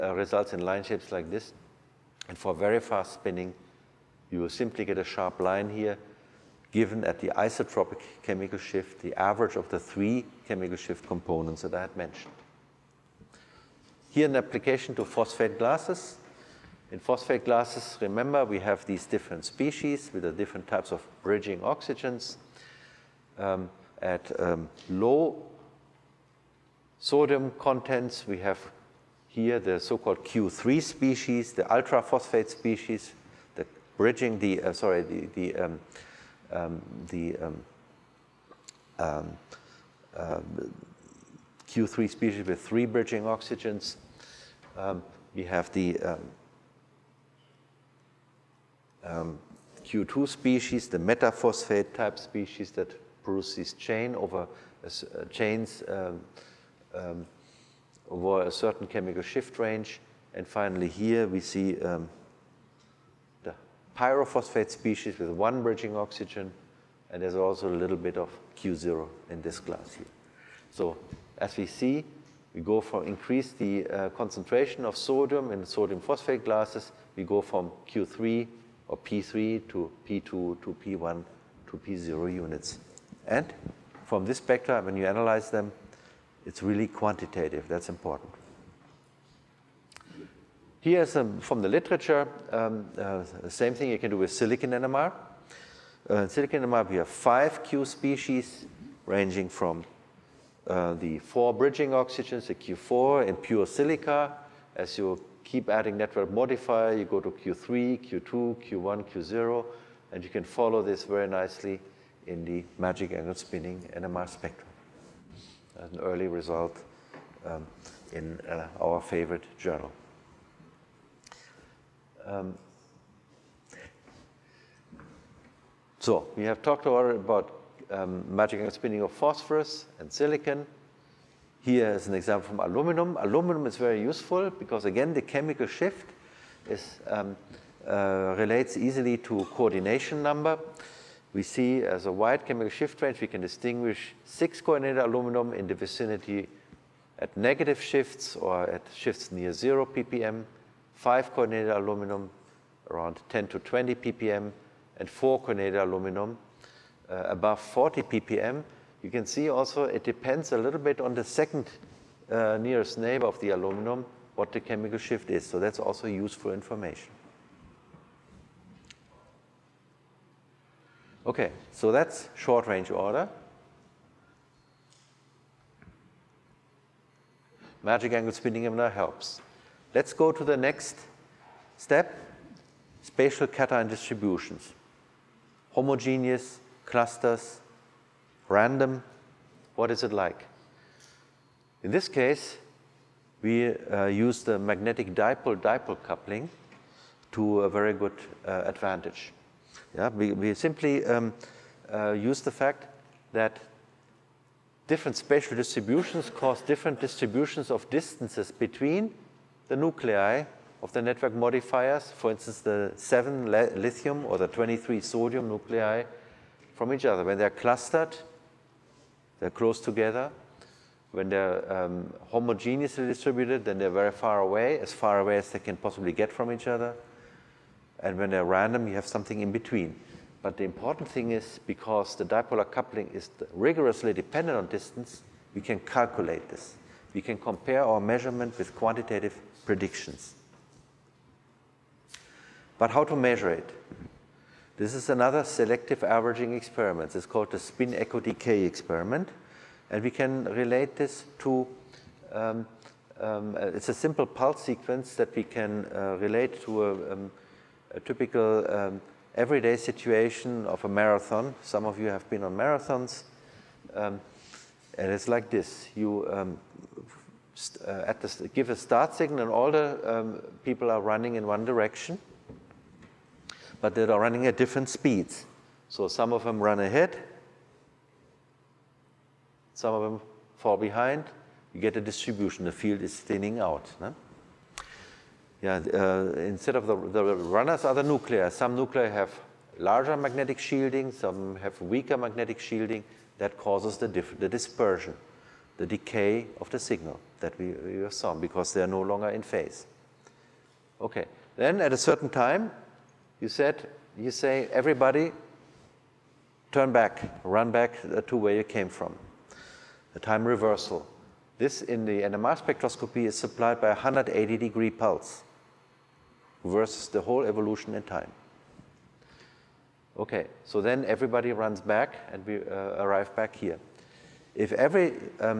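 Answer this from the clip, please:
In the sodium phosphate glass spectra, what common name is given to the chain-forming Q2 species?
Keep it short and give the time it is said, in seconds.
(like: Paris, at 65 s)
metaphosphate, at 50 s.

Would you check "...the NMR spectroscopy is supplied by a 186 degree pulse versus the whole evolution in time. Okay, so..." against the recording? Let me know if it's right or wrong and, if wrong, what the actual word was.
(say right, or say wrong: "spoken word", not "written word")
wrong: "180", not "186".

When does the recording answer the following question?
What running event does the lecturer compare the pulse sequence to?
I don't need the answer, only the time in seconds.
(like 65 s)
260 s.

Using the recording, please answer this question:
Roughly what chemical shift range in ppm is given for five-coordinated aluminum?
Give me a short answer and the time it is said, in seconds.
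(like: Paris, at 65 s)
10 to 20 ppm, at 153 s.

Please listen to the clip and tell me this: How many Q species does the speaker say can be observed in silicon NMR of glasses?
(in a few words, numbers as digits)
5.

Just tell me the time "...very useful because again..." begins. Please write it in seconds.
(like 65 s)
133 s.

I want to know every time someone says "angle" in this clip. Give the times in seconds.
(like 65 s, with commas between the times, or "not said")
113 s, 128 s, 178 s.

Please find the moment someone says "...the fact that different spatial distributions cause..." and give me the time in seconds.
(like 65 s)
202 s.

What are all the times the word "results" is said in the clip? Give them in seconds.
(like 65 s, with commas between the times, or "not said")
0 s, 116 s.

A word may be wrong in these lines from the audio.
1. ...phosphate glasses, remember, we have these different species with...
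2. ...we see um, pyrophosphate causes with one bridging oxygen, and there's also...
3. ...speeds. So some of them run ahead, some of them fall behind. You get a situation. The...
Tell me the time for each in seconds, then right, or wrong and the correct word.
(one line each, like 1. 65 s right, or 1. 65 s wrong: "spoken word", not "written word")
1. 16 s right
2. 61 s wrong: "species", not "causes"
3. 274 s wrong: "distribution", not "situation".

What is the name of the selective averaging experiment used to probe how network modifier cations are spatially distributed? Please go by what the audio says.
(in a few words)
spin echo decay experiment.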